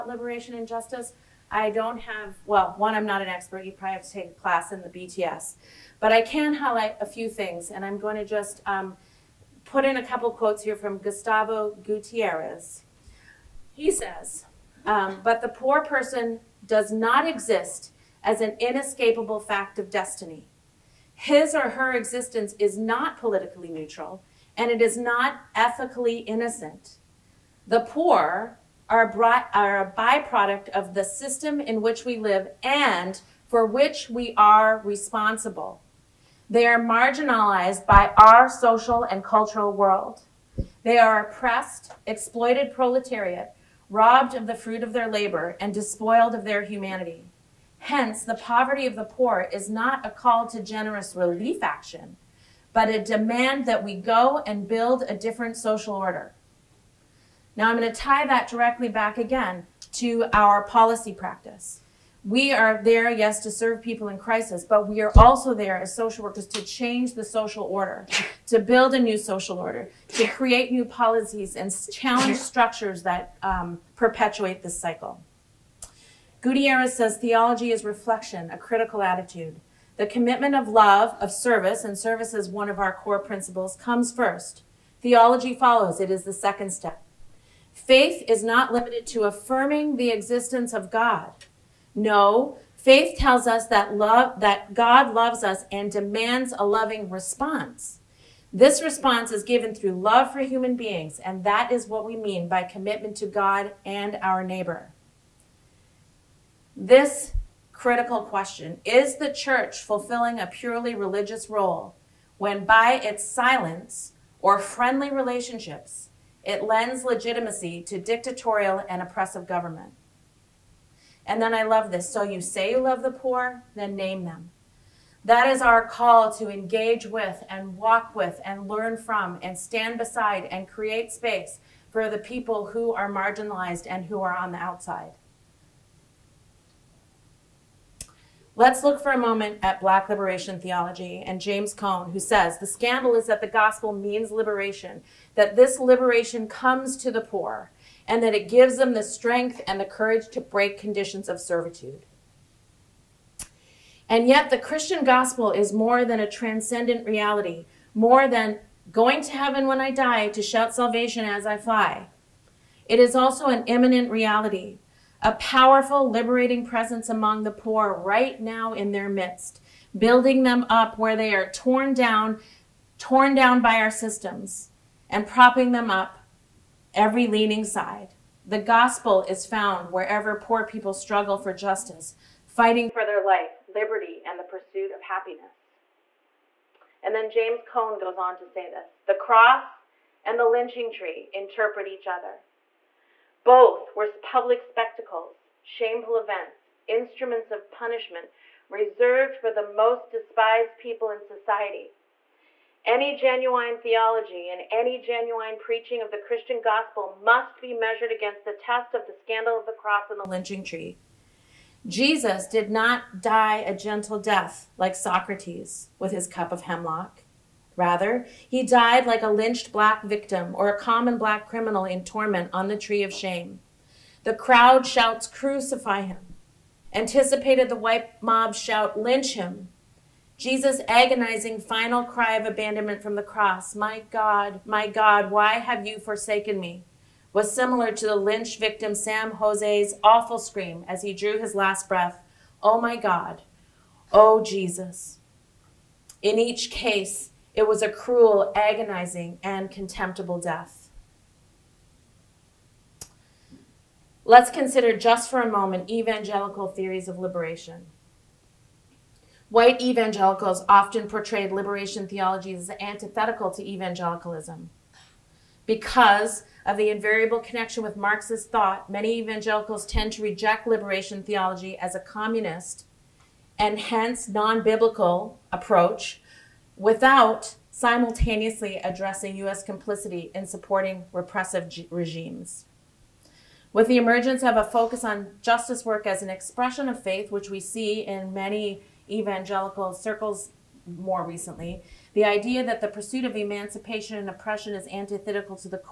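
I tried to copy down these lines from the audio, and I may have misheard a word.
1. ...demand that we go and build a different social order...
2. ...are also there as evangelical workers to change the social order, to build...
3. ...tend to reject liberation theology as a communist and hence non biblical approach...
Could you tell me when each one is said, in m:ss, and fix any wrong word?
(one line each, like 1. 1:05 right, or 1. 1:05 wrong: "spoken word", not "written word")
1. 0:53 right
2. 1:05 wrong: "social", not "evangelical"
3. 4:29 right.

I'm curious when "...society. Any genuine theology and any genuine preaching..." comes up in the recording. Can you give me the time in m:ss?
3:21.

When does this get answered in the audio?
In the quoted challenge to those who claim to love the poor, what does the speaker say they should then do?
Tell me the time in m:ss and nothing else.
2:03.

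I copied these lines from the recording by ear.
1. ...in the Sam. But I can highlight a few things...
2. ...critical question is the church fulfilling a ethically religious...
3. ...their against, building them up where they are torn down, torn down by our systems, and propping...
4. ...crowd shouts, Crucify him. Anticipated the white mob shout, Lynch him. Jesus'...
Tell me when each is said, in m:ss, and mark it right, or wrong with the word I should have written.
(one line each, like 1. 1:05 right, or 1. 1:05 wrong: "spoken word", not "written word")
1. 0:04 wrong: "BTS", not "Sam"
2. 1:47 wrong: "purely", not "ethically"
3. 2:48 wrong: "midst", not "against"
4. 3:44 right.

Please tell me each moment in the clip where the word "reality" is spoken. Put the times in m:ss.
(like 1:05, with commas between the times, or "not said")
2:37, 2:44.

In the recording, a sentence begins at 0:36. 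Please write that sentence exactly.
They are marginalized by our social and cultural world.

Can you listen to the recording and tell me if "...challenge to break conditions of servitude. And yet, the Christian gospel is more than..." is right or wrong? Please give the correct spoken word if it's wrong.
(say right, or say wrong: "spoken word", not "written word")
wrong: "courage", not "challenge".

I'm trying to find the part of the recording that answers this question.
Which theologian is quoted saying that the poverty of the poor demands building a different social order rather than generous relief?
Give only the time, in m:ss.
0:10.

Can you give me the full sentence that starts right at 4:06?
In each case, it was a cruel, agonizing, and contemptible death.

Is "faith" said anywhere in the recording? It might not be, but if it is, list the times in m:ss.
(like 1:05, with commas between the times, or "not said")
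1:27, 1:32, 4:47.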